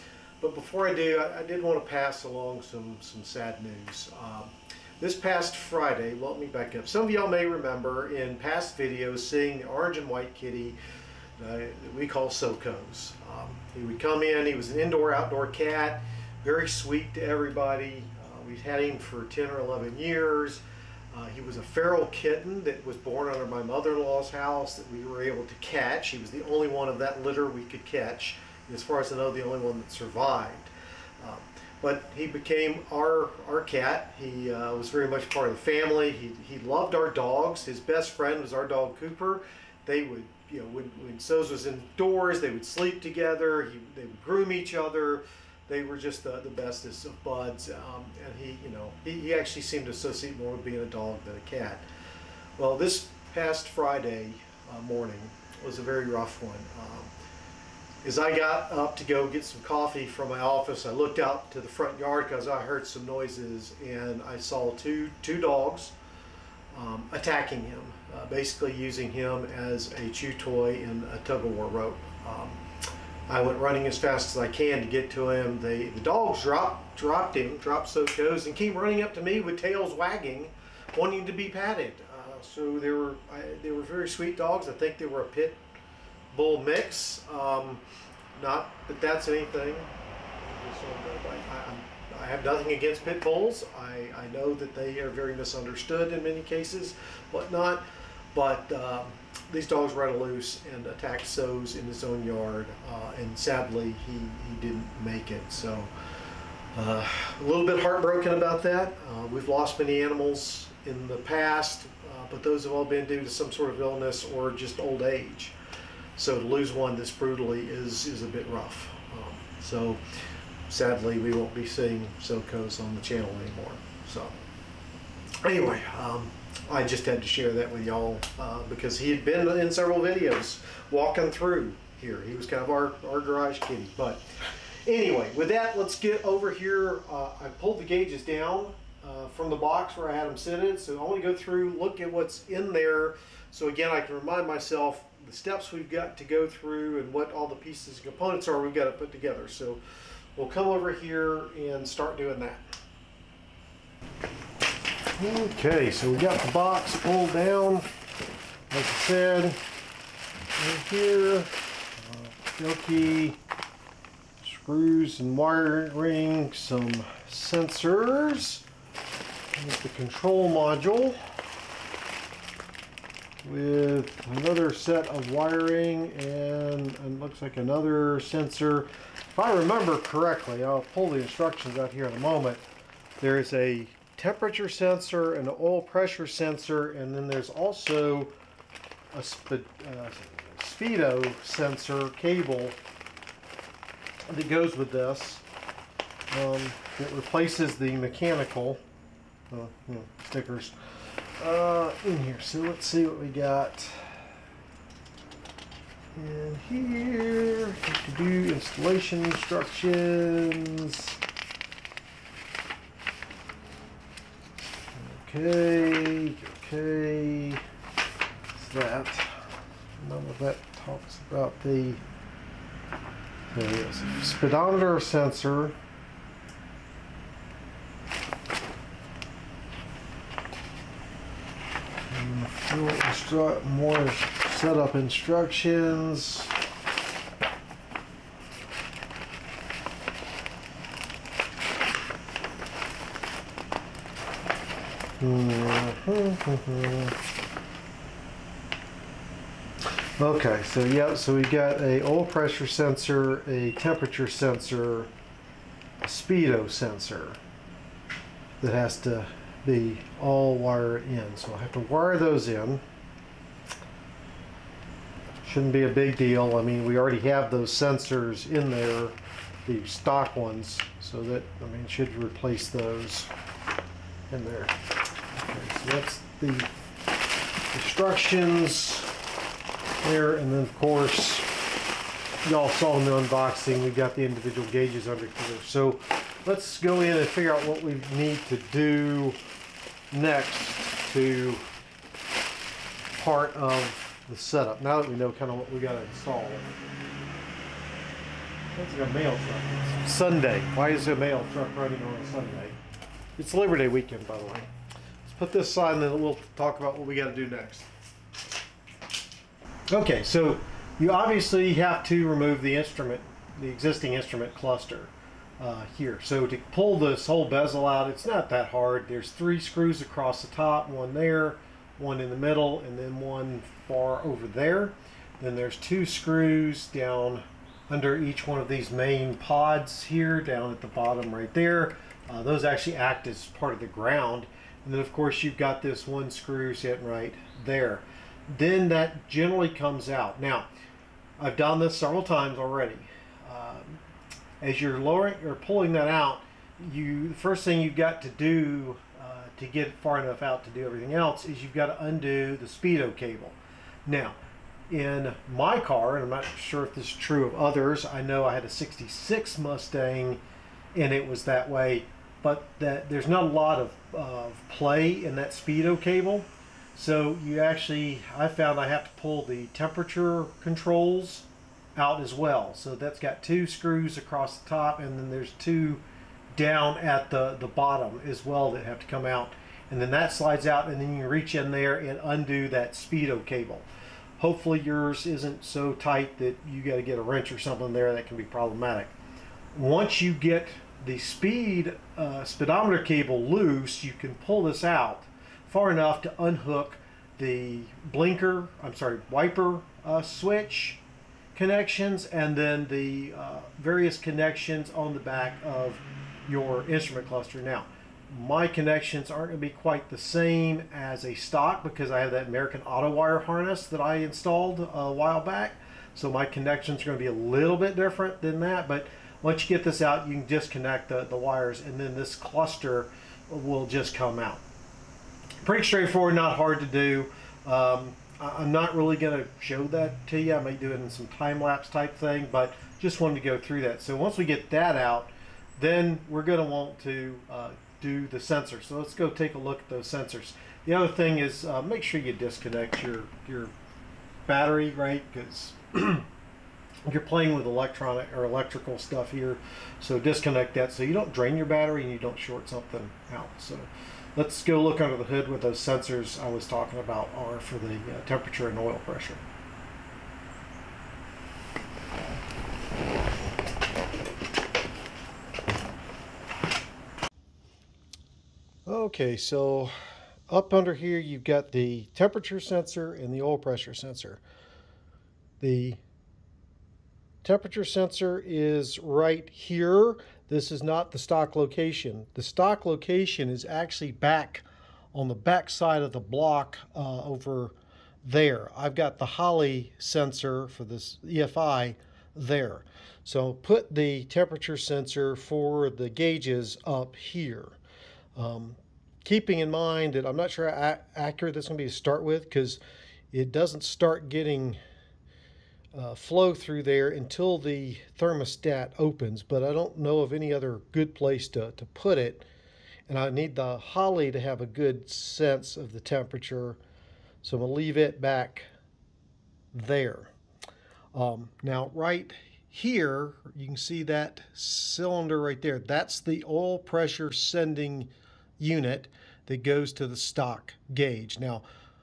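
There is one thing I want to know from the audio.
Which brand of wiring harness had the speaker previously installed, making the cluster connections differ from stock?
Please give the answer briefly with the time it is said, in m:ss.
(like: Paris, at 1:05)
American Autowire, at 6:52.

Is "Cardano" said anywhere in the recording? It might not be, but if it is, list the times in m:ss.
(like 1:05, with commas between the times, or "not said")
not said.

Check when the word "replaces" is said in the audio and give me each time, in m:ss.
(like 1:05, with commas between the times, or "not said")
3:17, 4:32.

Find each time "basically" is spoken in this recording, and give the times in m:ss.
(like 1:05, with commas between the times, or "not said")
1:08.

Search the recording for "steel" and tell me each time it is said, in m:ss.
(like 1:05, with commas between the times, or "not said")
not said.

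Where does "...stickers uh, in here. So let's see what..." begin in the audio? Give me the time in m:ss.
3:20.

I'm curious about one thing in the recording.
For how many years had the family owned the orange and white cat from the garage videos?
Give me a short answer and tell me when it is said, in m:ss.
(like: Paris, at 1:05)
10 or 11, at 0:19.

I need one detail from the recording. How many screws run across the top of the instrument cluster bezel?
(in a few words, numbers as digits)
3.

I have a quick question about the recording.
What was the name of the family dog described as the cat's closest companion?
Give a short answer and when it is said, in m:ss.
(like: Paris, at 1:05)
Cooper, at 0:38.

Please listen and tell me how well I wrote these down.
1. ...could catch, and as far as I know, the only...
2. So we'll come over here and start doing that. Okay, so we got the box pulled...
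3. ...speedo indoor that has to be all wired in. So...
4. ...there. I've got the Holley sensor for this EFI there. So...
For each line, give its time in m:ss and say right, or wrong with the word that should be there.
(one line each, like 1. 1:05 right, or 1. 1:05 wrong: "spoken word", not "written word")
1. 0:27 right
2. 2:29 right
3. 4:16 wrong: "sensor", not "indoor"
4. 8:08 right.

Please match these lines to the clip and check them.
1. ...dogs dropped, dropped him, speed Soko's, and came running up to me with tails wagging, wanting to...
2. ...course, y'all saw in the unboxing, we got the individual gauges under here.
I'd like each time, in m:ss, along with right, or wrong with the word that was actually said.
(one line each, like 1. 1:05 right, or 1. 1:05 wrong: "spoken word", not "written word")
1. 1:16 wrong: "dropped", not "speed"
2. 4:40 right.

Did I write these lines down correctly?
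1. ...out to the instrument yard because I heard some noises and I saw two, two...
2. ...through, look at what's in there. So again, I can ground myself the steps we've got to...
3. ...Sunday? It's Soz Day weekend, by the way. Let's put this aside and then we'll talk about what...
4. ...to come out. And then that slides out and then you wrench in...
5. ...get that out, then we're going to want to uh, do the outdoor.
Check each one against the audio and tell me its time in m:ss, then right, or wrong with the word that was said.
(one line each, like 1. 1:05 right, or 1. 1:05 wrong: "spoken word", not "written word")
1. 1:01 wrong: "front", not "instrument"
2. 2:21 wrong: "remind", not "ground"
3. 5:02 wrong: "Labor", not "Soz"
4. 6:19 wrong: "reach", not "wrench"
5. 7:14 wrong: "sensor", not "outdoor".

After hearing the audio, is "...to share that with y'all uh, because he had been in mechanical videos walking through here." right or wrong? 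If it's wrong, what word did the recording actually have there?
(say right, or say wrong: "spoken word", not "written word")
wrong: "several", not "mechanical".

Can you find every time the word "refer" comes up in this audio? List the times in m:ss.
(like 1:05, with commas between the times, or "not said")
not said.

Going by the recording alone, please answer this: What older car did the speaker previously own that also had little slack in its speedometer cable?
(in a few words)
66 Mustang.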